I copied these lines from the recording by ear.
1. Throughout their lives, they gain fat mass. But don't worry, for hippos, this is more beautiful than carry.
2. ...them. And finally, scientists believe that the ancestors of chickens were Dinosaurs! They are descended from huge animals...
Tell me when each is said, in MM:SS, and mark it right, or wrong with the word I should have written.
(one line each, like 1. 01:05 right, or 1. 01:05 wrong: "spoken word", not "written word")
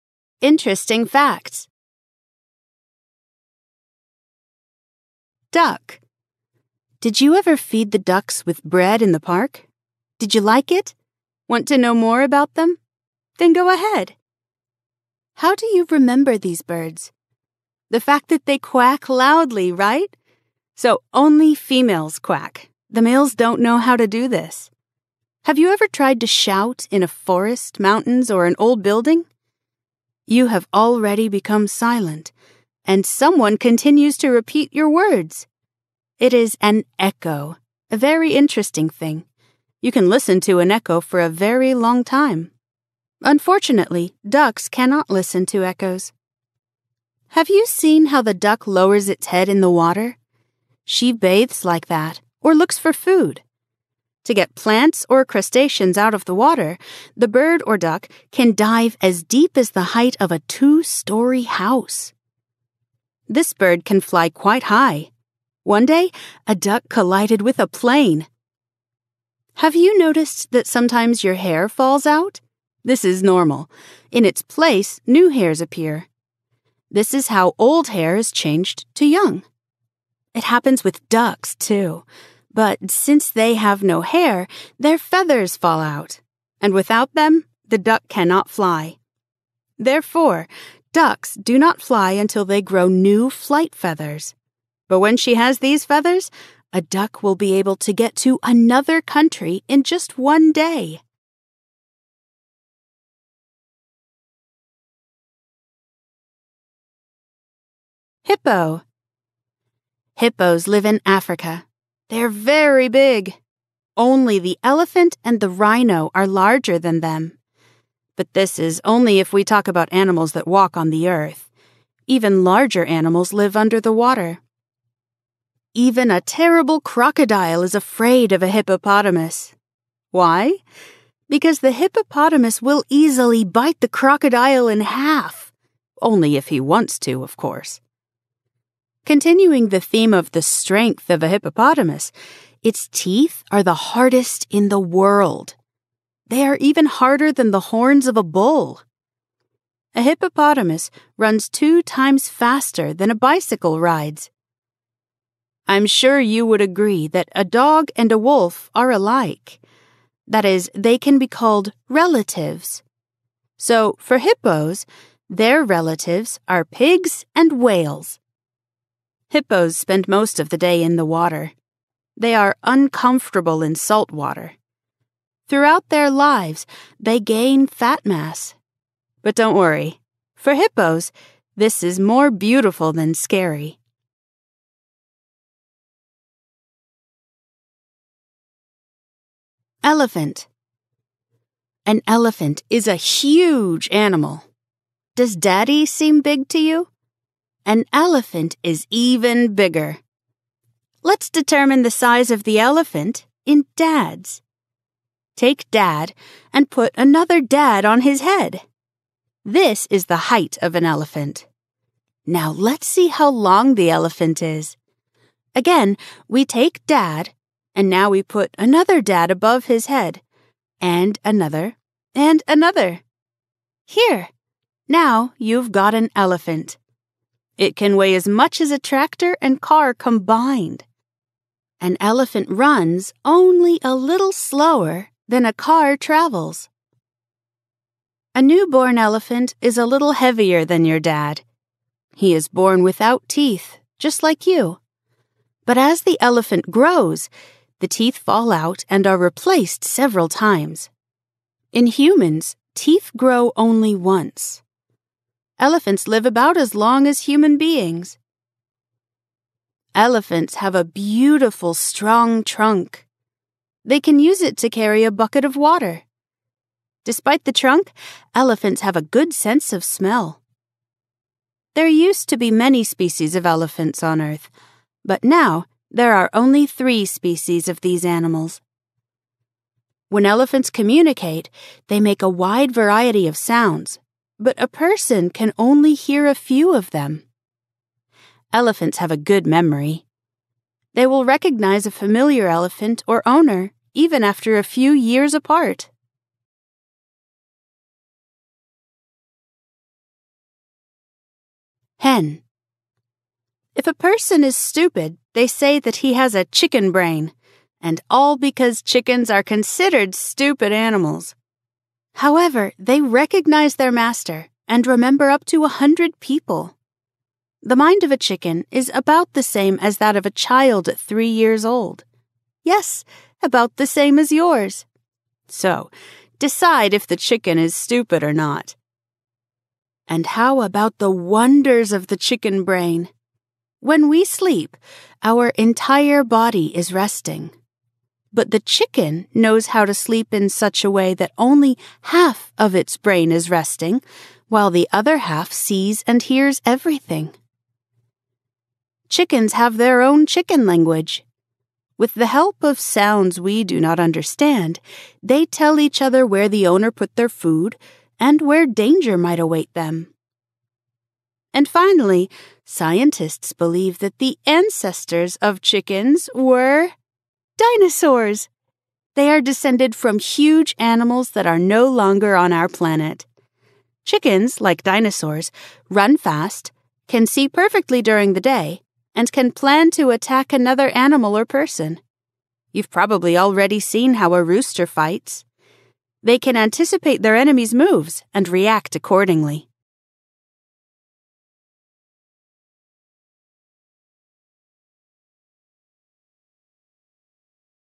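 1. 02:55 wrong: "scary", not "carry"
2. 05:59 right.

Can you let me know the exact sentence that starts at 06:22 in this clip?
You've probably already seen how a rooster fights.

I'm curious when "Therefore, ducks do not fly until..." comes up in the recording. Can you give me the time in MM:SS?
01:29.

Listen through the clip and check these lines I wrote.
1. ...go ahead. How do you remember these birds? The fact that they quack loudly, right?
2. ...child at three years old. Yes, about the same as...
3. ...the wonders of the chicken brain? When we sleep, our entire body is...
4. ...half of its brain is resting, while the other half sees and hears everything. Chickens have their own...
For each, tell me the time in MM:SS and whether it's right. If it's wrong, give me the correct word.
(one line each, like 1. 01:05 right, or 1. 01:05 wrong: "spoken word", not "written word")
1. 00:13 right
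2. 05:20 right
3. 05:30 right
4. 05:42 right.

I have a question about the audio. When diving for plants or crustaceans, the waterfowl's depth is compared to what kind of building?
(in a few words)
two story house.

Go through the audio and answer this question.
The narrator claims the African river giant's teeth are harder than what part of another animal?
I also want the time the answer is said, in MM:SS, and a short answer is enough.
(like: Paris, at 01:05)
horns of a bull, at 02:27.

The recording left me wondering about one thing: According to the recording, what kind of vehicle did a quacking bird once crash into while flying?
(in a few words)
a plane.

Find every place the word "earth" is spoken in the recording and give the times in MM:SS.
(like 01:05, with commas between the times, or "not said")
02:01, 04:34.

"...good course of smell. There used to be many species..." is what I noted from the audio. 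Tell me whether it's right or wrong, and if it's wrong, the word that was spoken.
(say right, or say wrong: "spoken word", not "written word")
wrong: "sense", not "course".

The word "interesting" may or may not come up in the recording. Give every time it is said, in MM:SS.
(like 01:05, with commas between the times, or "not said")
00:00, 00:38.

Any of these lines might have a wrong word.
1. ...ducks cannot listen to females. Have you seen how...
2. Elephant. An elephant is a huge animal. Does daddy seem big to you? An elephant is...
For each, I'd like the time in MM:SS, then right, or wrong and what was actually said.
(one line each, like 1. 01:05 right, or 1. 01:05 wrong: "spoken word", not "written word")
1. 00:44 wrong: "echoes", not "females"
2. 03:09 right.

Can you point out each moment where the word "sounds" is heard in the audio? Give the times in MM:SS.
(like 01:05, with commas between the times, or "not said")
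04:43, 05:52.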